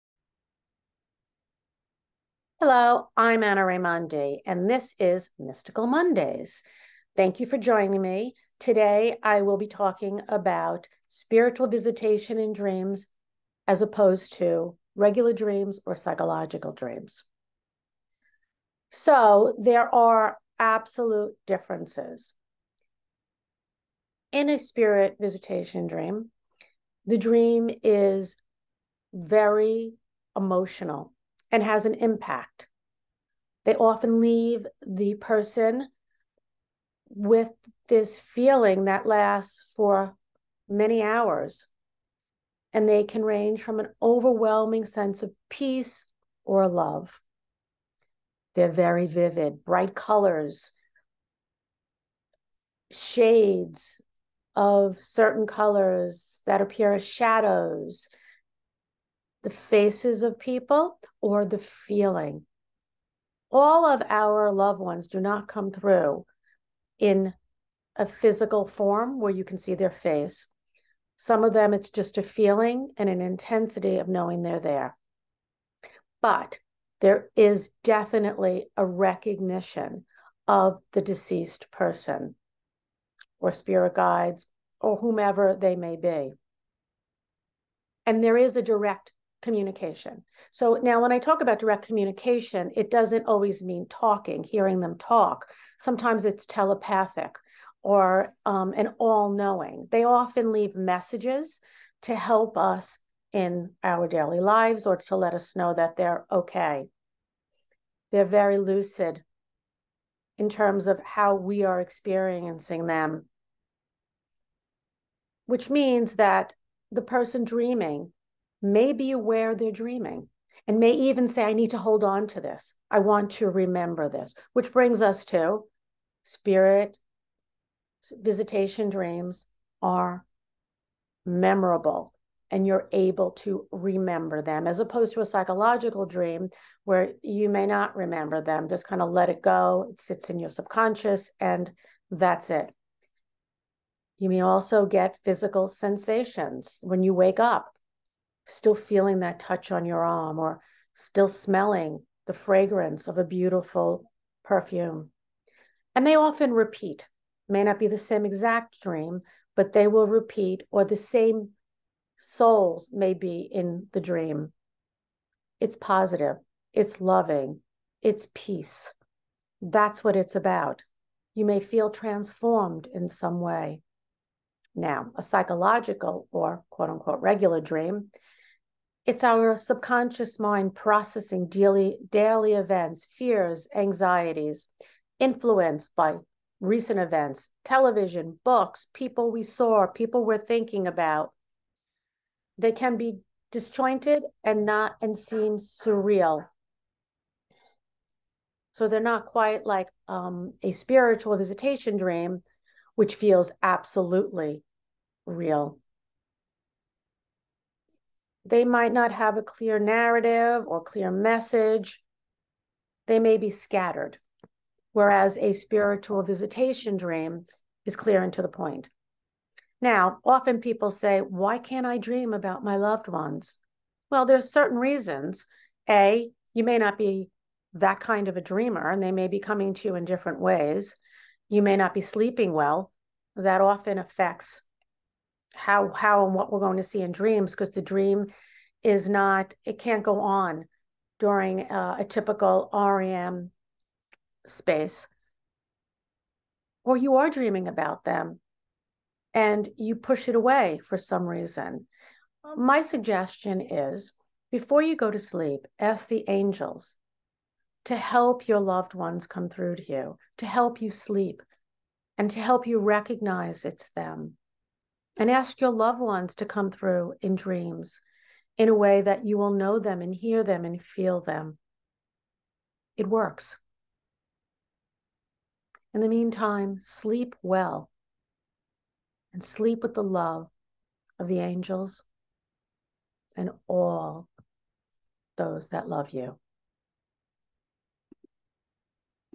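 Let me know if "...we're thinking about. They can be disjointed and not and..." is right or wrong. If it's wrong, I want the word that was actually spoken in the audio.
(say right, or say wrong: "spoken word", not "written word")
right.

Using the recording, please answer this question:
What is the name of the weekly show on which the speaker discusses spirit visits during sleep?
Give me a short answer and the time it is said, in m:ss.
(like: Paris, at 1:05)
Mystical Mondays, at 0:05.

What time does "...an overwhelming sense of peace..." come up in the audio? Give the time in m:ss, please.
0:43.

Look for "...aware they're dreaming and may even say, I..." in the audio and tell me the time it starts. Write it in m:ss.
1:59.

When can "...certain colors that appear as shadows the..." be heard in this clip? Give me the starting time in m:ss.
0:55.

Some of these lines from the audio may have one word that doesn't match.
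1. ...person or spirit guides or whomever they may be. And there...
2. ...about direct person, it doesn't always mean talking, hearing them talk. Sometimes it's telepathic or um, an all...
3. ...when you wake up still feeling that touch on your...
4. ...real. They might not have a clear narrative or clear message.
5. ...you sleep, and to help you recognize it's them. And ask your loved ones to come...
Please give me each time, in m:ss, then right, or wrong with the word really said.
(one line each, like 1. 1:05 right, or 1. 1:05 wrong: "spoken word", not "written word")
1. 1:21 right
2. 1:31 wrong: "communication", not "person"
3. 2:26 right
4. 3:25 right
5. 4:20 right.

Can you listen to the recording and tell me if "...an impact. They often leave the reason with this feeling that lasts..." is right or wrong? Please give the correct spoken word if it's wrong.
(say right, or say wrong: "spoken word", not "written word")
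wrong: "person", not "reason".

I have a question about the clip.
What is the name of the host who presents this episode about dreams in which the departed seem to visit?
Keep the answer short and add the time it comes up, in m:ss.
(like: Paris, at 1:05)
Anna Raimondi, at 0:03.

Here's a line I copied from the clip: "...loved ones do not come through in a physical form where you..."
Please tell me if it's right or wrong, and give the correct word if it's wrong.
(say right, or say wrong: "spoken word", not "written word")
right.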